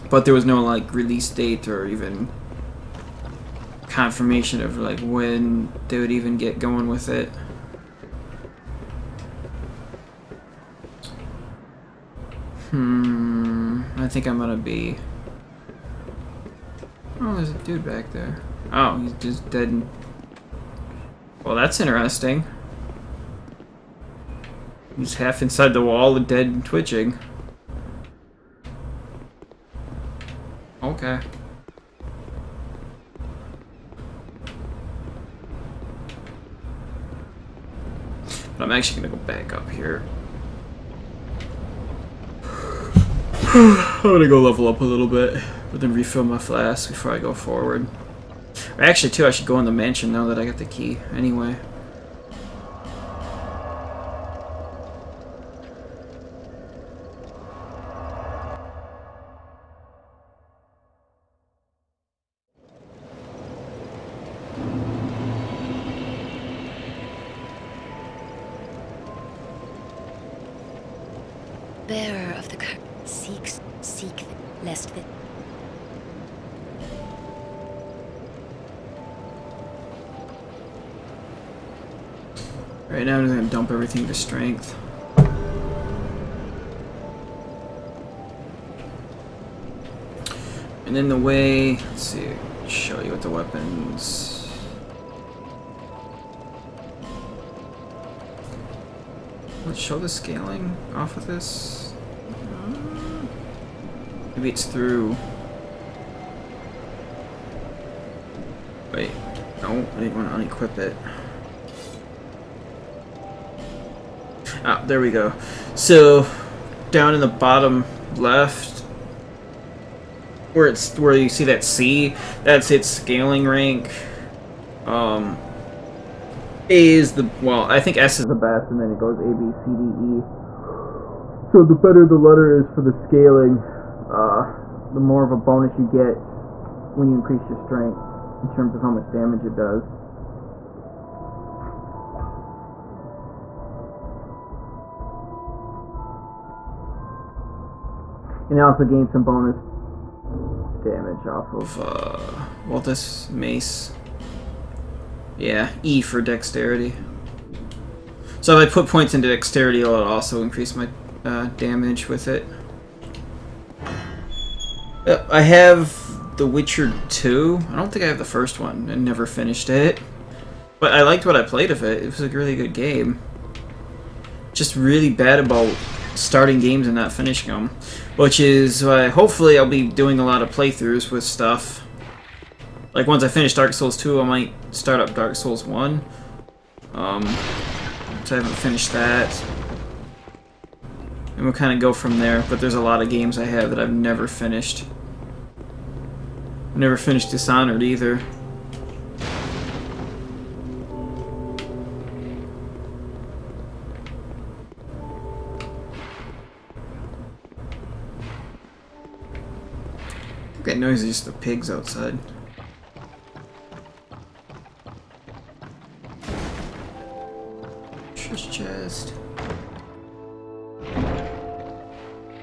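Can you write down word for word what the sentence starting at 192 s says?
But there's a lot of games I have that I've never finished.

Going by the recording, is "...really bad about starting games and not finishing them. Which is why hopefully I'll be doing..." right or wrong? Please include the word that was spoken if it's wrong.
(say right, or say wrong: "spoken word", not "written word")
right.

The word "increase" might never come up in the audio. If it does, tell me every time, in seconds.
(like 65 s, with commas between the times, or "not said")
137 s, 160 s.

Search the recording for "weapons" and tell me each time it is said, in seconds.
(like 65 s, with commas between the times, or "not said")
93 s.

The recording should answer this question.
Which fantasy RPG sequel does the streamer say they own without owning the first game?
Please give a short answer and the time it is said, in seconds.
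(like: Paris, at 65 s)
The Witcher 2, at 166 s.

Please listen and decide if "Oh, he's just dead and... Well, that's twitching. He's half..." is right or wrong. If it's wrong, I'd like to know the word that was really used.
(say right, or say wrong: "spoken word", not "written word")
wrong: "interesting", not "twitching".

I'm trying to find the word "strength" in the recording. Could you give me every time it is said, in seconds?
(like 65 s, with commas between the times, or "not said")
84 s, 137 s.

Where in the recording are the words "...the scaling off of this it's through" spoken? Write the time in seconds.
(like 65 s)
99 s.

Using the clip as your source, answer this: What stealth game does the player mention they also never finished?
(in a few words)
Dishonored.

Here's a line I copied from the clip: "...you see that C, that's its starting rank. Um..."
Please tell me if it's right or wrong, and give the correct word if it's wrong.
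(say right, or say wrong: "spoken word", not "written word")
wrong: "scaling", not "starting".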